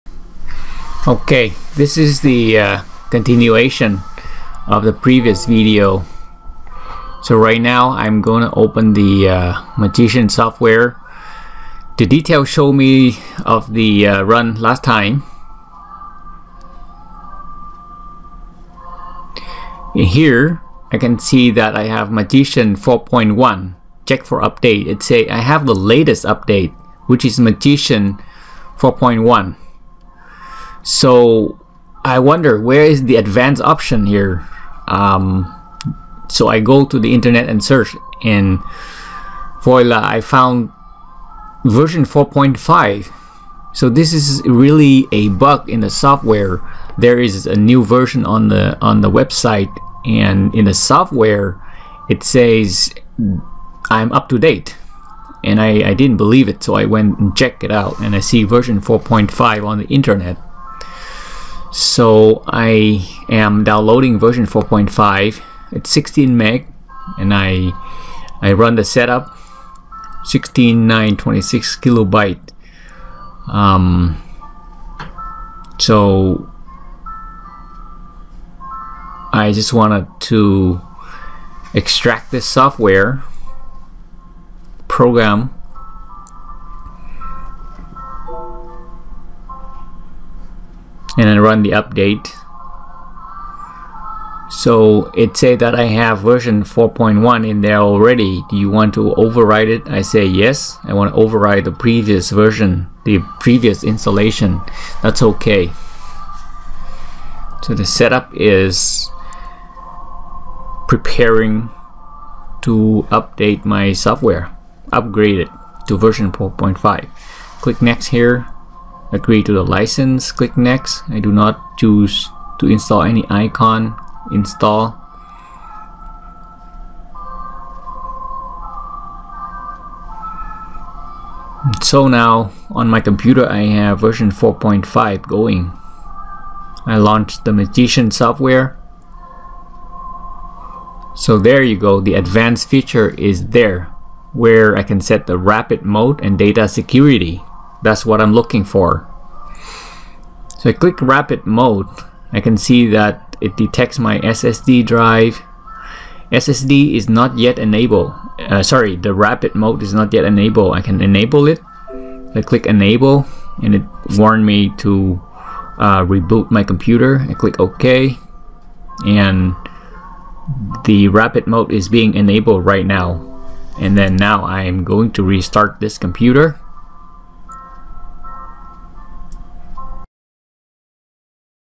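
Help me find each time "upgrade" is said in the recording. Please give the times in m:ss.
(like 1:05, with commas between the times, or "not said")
1:54.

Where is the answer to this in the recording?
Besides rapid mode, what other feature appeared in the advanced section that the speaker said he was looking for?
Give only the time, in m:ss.
2:26.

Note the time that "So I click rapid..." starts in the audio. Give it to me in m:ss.
2:30.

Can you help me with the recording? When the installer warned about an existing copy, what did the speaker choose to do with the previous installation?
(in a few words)
override it.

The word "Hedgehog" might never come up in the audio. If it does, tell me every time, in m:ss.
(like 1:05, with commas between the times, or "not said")
not said.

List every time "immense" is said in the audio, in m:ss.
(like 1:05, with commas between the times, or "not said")
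not said.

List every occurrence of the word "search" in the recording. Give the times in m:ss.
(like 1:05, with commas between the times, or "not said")
0:37.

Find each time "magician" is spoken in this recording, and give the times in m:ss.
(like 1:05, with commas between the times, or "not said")
0:09, 0:22, 0:27, 2:17.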